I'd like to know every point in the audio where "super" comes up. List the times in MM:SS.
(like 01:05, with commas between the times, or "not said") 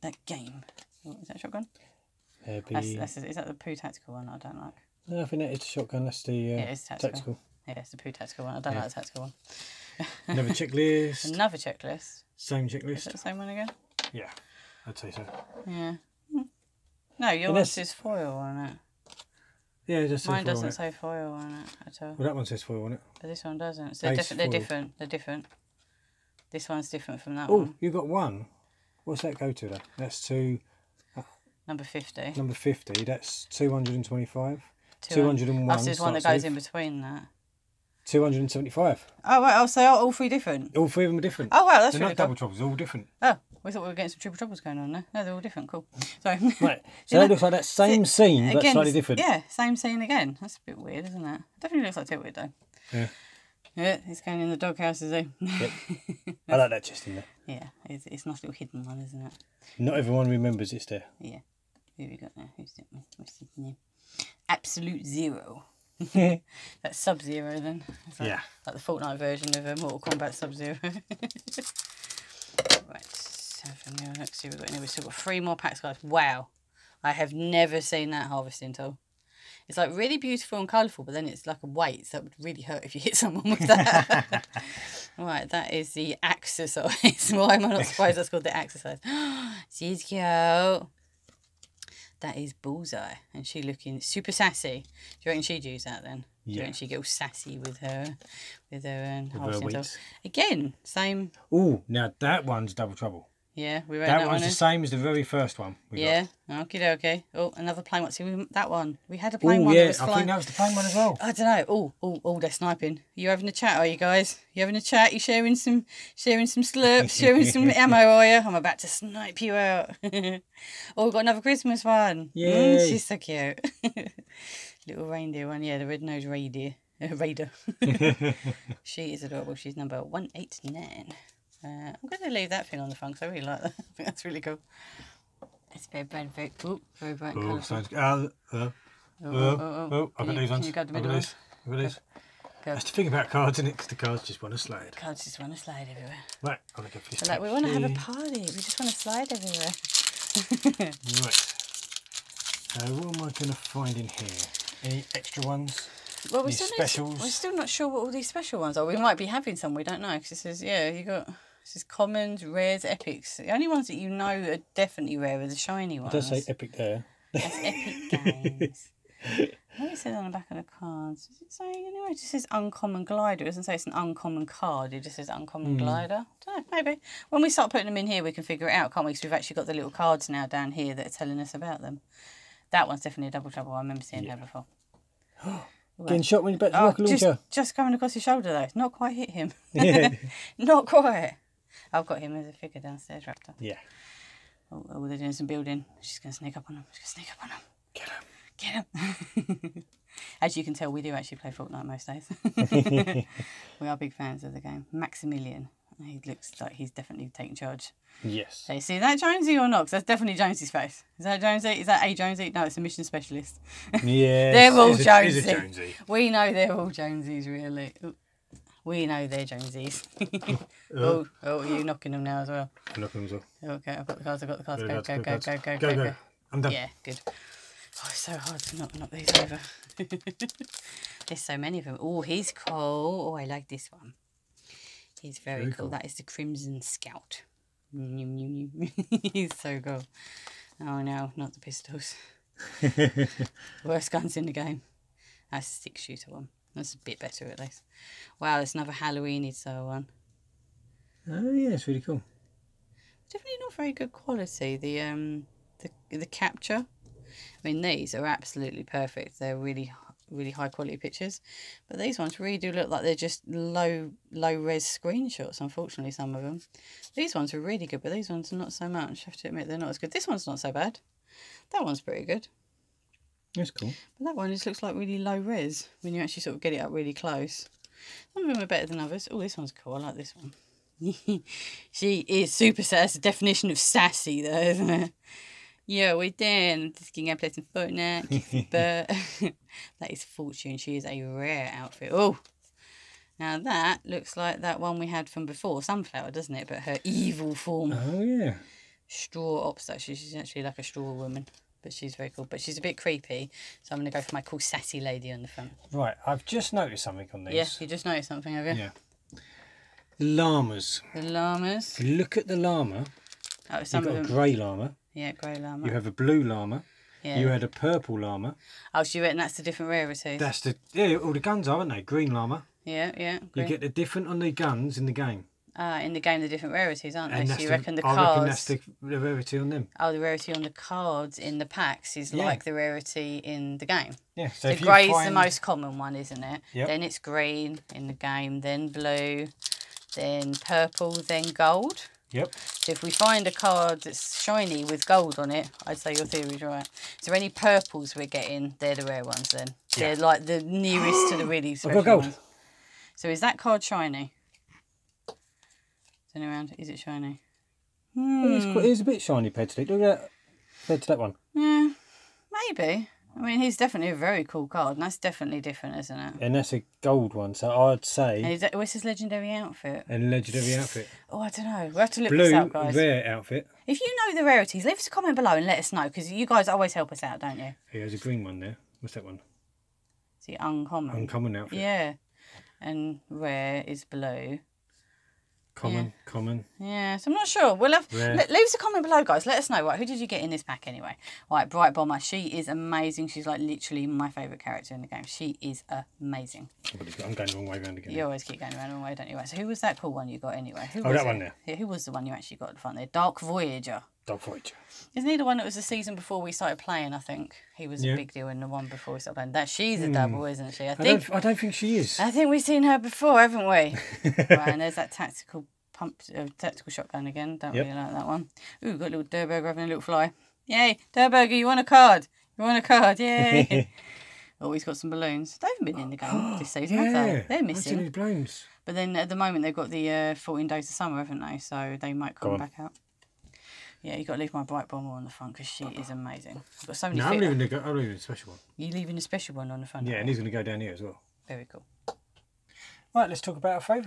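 01:34, 04:42.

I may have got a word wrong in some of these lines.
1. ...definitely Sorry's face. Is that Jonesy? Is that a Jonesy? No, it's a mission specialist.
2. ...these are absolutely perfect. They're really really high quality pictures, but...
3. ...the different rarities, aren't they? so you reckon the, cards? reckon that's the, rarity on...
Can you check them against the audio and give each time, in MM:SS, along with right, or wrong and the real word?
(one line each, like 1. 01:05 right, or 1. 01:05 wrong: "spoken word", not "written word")
1. 03:30 wrong: "Jonesy", not "Sorry"
2. 04:17 right
3. 05:26 right.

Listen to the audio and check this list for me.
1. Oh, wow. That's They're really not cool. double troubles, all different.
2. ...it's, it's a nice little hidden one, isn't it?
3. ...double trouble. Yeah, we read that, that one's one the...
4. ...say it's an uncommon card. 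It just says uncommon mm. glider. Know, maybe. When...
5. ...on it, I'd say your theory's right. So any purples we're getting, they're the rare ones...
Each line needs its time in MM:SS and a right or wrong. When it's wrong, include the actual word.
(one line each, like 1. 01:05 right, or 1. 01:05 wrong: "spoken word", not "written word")
1. 00:41 right
2. 00:57 right
3. 01:42 right
4. 02:53 right
5. 05:45 right.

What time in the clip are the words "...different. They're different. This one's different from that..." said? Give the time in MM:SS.
00:24.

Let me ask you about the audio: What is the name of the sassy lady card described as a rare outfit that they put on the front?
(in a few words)
Fortune.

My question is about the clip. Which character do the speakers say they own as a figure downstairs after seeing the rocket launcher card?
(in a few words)
Raptor.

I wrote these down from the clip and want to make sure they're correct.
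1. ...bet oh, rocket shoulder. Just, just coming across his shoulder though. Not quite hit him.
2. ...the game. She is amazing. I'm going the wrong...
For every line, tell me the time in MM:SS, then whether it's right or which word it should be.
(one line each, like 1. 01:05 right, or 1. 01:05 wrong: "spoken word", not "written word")
1. 03:06 wrong: "launcher", not "shoulder"
2. 06:35 right.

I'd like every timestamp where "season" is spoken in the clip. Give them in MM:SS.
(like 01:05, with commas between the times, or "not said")
06:45, 07:06.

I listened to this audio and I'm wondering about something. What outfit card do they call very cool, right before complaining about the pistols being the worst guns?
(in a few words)
Crimson Scout.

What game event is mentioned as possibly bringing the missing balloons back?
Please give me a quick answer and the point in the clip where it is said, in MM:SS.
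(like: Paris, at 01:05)
14 days of summer, at 07:10.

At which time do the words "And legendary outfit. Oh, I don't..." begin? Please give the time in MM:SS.
06:10.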